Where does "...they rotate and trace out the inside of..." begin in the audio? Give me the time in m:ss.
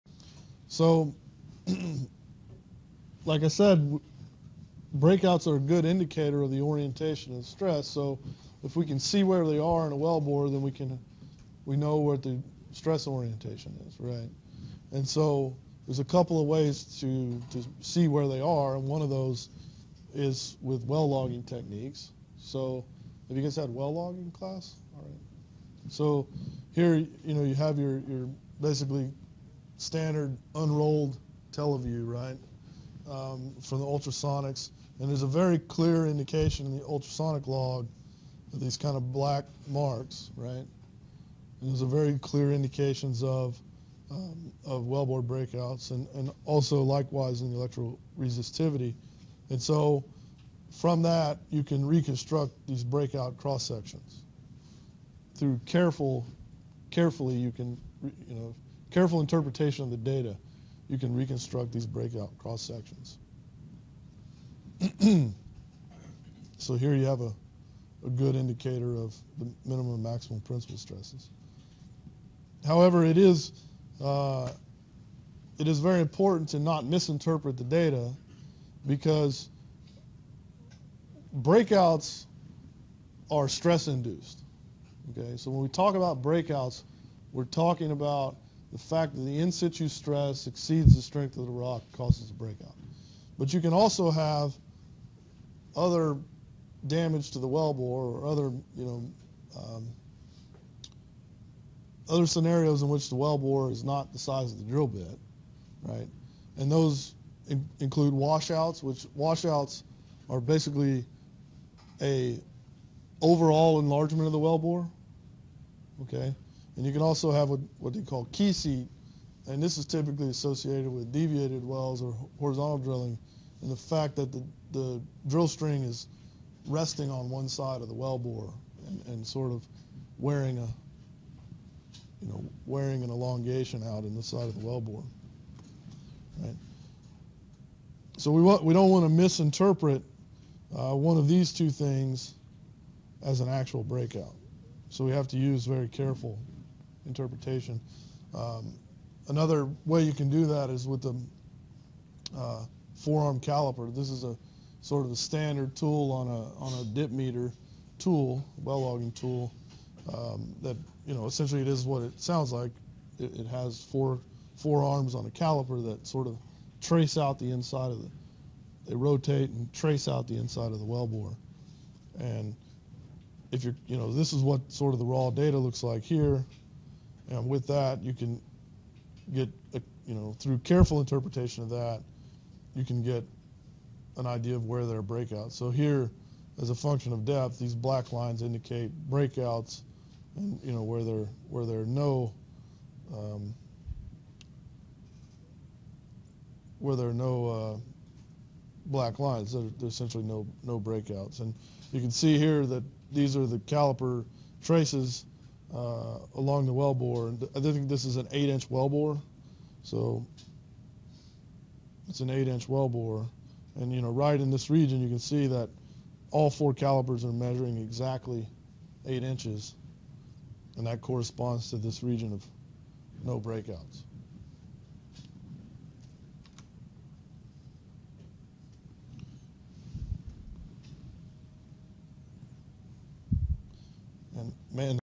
2:48.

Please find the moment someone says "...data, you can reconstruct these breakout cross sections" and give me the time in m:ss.
0:59.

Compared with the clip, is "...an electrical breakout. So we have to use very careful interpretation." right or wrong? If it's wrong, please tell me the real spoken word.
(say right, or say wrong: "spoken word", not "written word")
wrong: "actual", not "electrical".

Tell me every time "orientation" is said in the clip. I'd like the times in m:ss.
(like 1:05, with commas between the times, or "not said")
0:06, 0:13.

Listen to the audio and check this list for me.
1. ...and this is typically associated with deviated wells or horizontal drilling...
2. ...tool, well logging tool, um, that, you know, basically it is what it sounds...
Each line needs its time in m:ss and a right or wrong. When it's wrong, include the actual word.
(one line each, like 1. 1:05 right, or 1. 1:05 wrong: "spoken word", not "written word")
1. 1:59 right
2. 2:37 wrong: "essentially", not "basically".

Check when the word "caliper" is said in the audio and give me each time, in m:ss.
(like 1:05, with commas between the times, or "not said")
2:33, 2:45, 3:23, 3:36.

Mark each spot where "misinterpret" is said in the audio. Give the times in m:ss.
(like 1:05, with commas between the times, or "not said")
1:16, 2:19.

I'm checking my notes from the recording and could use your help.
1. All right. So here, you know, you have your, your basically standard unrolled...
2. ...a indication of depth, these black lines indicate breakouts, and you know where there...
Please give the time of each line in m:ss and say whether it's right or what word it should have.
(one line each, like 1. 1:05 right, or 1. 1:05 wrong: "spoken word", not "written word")
1. 0:24 right
2. 3:06 wrong: "function", not "indication".